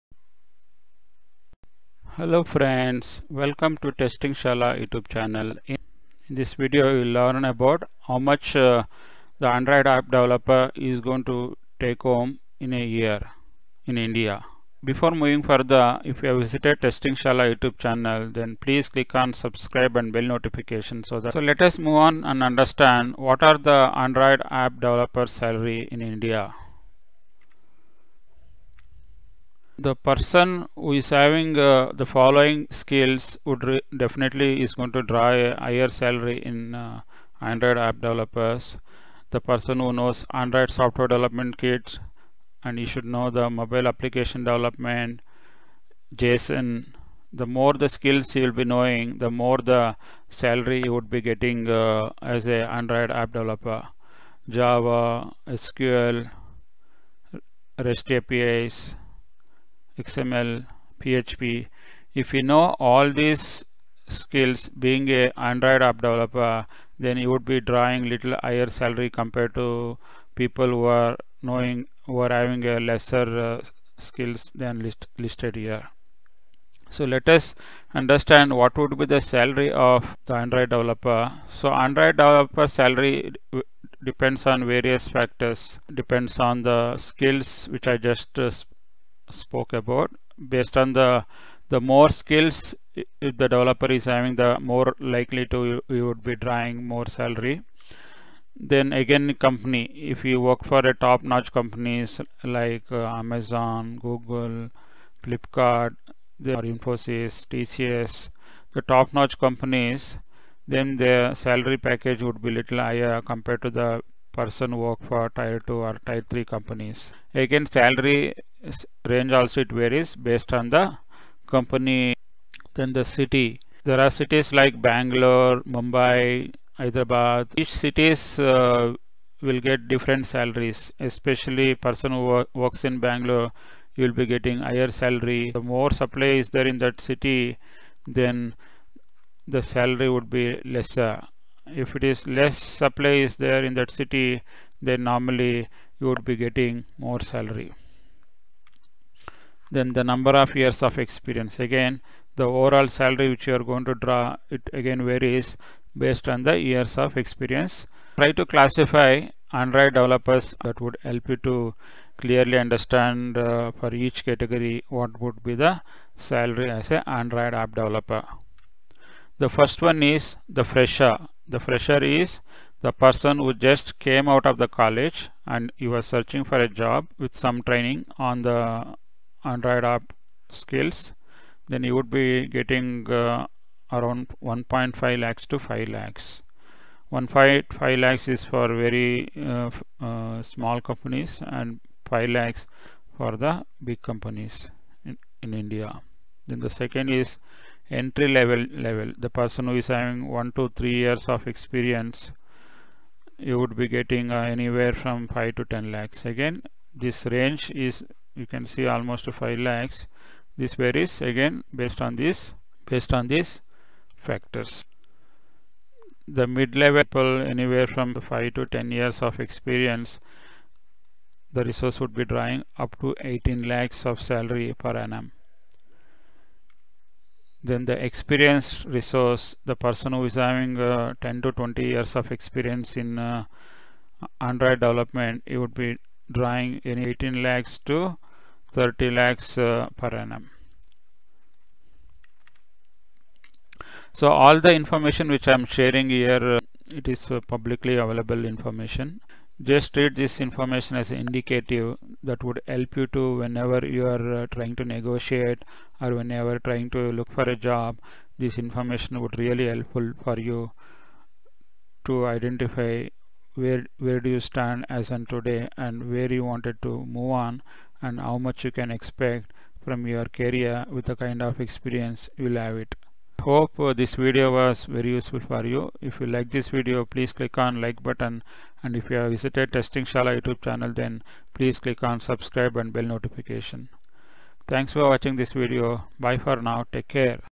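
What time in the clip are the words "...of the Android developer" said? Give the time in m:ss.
1:19.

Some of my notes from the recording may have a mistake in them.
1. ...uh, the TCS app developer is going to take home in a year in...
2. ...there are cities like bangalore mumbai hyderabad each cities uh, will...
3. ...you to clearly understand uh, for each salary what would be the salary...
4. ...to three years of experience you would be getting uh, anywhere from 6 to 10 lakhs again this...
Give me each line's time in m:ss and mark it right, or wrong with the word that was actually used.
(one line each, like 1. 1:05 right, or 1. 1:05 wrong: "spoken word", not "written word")
1. 0:08 wrong: "Android", not "TCS"
2. 2:03 right
3. 2:41 wrong: "category", not "salary"
4. 3:20 wrong: "5", not "6".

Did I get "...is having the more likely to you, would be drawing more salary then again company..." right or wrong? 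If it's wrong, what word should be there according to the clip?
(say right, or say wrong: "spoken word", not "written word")
right.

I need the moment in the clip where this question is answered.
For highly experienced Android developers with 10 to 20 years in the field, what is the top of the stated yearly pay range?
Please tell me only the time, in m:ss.
3:58.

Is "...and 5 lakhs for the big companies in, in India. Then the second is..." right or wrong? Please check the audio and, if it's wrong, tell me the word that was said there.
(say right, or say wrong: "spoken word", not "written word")
right.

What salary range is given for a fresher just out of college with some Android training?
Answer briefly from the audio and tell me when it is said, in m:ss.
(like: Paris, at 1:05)
1.5 lakhs to 5 lakhs, at 3:04.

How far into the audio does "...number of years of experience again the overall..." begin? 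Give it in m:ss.
2:30.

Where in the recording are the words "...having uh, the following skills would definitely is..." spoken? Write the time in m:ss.
0:31.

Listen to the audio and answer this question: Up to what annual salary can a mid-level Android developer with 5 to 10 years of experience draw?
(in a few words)
18 lakhs.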